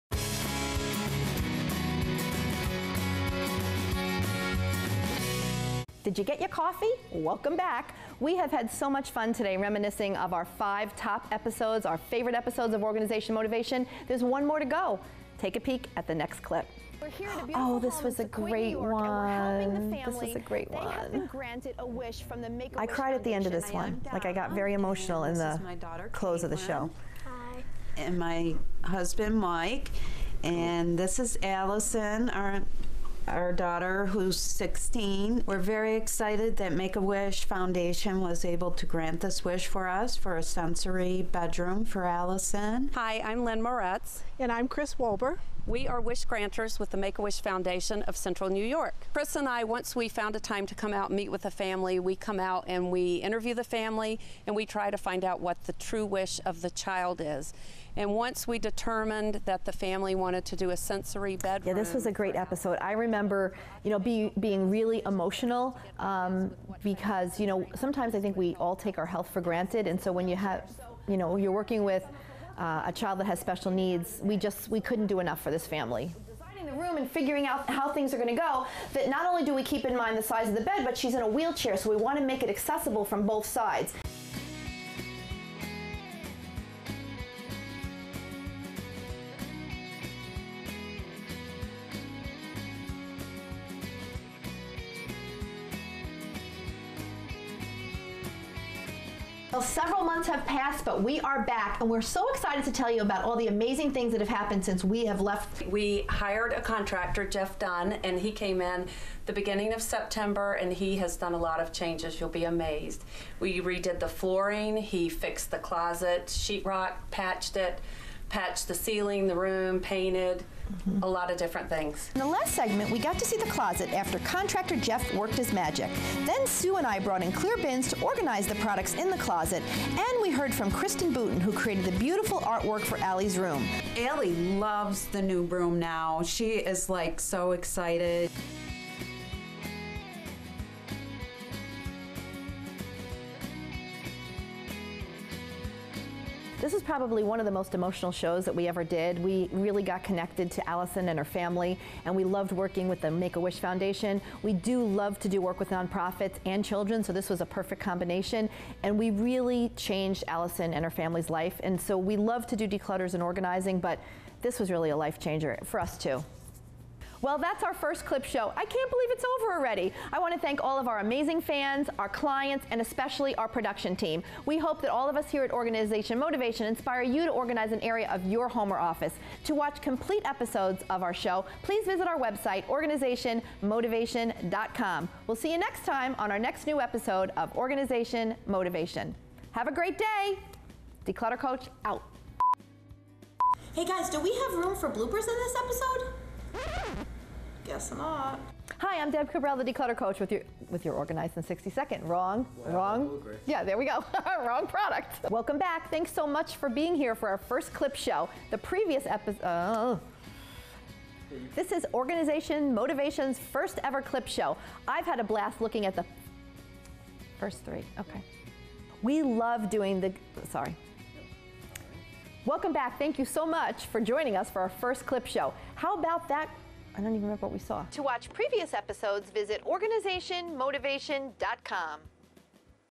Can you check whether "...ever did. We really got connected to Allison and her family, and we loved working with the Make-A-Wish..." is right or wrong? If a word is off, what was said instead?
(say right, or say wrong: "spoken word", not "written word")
right.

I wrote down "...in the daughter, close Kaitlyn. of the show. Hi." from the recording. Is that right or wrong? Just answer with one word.
right.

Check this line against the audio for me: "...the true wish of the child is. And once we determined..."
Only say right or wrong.
right.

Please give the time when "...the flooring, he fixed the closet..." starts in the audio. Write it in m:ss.
1:53.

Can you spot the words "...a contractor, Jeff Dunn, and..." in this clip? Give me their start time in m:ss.
1:46.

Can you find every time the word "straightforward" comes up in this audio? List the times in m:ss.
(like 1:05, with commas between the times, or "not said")
not said.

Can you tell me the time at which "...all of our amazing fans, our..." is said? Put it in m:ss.
2:50.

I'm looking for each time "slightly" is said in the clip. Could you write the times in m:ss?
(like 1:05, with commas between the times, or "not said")
not said.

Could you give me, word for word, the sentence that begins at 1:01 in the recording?
Yeah, this was a great episode.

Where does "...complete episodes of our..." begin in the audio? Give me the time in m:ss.
2:59.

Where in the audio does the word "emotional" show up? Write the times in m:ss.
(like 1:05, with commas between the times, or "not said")
0:24, 1:05, 2:27.